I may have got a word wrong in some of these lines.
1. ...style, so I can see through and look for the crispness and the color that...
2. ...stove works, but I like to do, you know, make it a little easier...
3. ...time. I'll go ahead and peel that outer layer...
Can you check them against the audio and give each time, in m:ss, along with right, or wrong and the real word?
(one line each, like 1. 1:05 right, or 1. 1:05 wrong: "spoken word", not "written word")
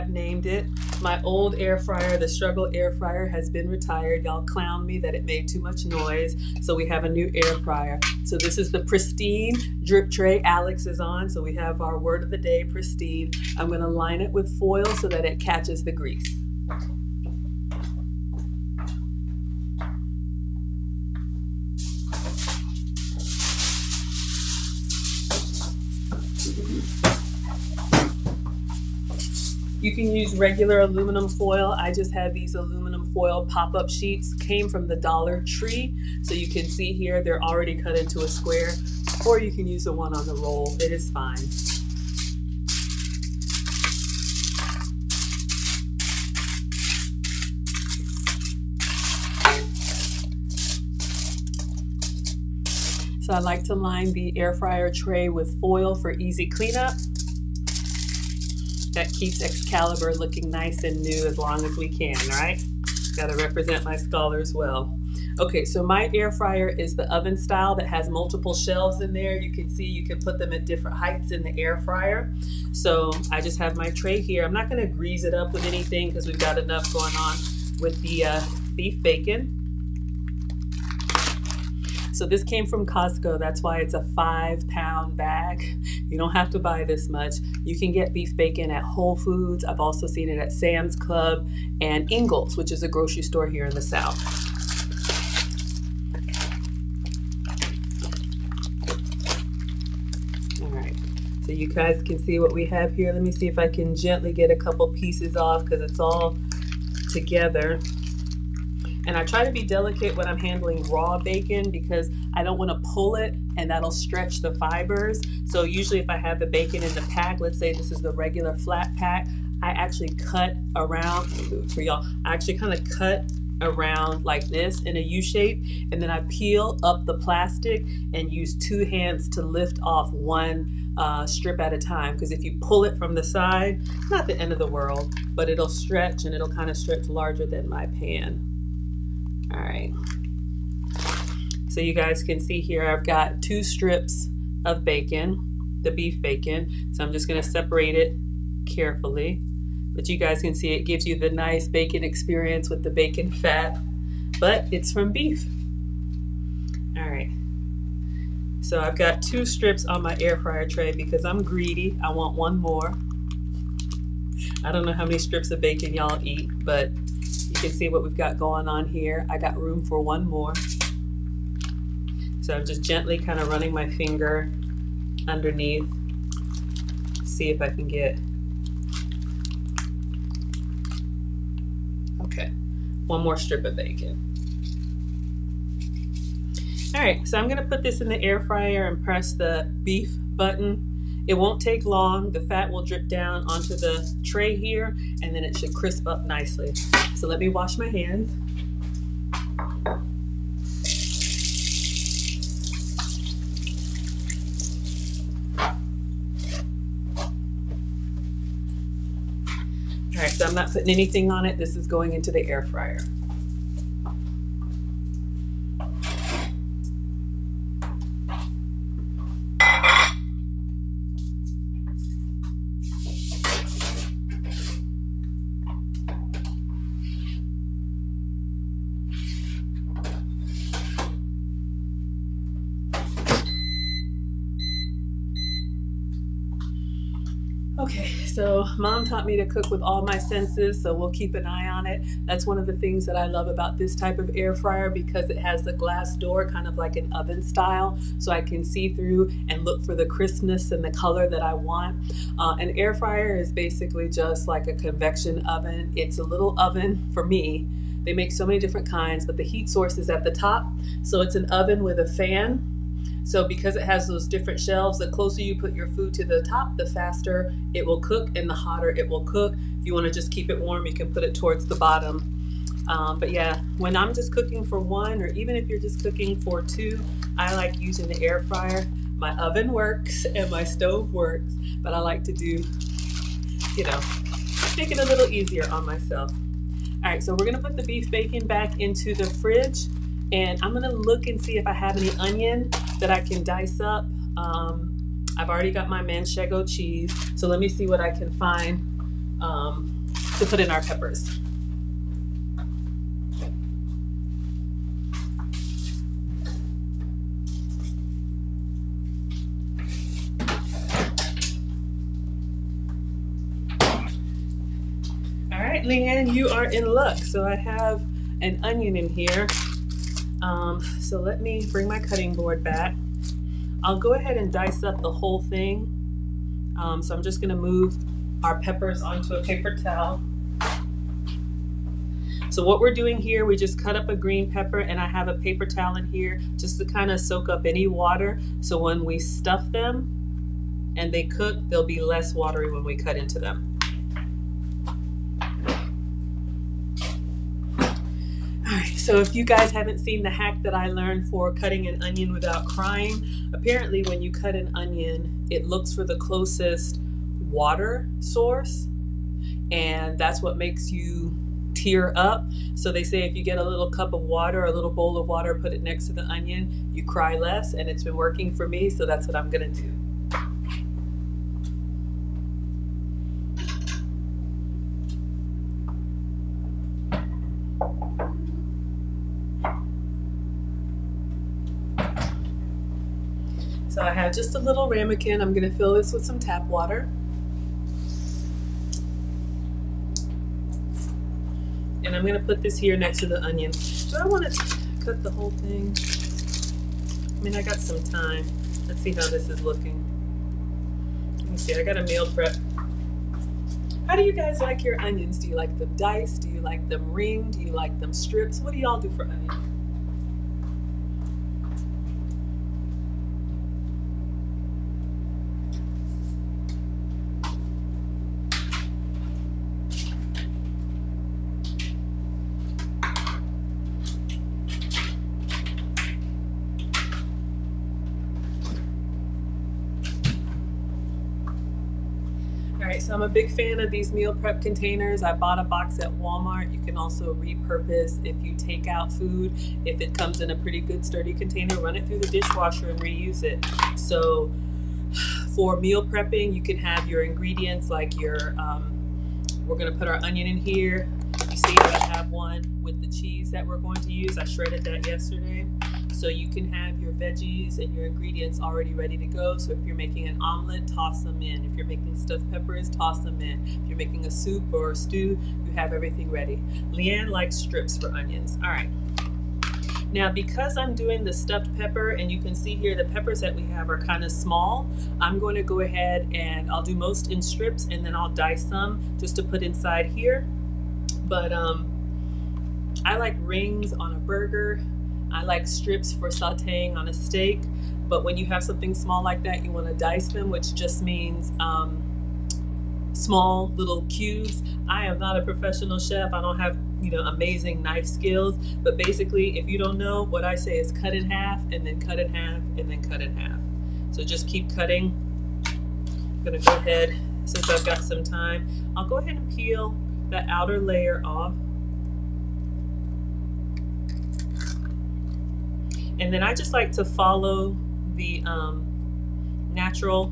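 1. 4:07 right
2. 4:40 right
3. 8:28 right.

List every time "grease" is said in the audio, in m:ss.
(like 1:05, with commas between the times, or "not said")
0:15, 1:14.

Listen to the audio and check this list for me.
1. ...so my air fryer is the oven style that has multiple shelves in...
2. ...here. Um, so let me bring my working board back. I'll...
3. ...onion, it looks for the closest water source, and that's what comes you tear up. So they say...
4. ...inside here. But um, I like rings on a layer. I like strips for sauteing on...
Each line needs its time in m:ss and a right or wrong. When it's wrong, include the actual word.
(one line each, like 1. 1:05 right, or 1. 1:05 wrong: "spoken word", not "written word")
1. 1:05 right
2. 5:19 wrong: "cutting", not "working"
3. 5:54 wrong: "makes", not "comes"
4. 7:59 wrong: "burger", not "layer".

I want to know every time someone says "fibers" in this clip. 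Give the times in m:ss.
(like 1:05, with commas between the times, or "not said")
1:54.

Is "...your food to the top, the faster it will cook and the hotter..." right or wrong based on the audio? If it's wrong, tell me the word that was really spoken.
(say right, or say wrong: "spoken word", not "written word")
right.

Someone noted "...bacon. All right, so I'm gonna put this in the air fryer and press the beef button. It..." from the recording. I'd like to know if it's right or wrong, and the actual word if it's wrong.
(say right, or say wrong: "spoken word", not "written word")
right.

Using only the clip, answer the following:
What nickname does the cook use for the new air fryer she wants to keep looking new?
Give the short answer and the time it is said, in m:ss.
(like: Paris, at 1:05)
Excalibur, at 0:59.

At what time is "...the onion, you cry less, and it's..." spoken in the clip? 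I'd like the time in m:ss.
6:06.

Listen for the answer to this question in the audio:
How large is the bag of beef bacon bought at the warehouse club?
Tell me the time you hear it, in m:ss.
1:24.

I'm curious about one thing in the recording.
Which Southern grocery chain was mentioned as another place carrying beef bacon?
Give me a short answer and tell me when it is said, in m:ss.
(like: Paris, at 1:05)
Ingles, at 1:32.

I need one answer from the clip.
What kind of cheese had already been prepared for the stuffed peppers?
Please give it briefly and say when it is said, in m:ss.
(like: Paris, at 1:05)
manchego, at 4:56.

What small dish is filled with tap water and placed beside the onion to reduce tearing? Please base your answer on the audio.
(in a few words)
ramekin.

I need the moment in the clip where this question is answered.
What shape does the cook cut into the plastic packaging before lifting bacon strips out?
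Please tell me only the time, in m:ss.
2:04.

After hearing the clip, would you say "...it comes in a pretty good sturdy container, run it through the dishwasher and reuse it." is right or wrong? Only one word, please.
right.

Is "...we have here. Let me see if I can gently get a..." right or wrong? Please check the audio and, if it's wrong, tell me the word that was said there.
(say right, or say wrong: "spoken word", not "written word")
right.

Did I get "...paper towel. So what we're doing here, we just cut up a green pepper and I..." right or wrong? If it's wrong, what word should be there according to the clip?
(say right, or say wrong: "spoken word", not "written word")
right.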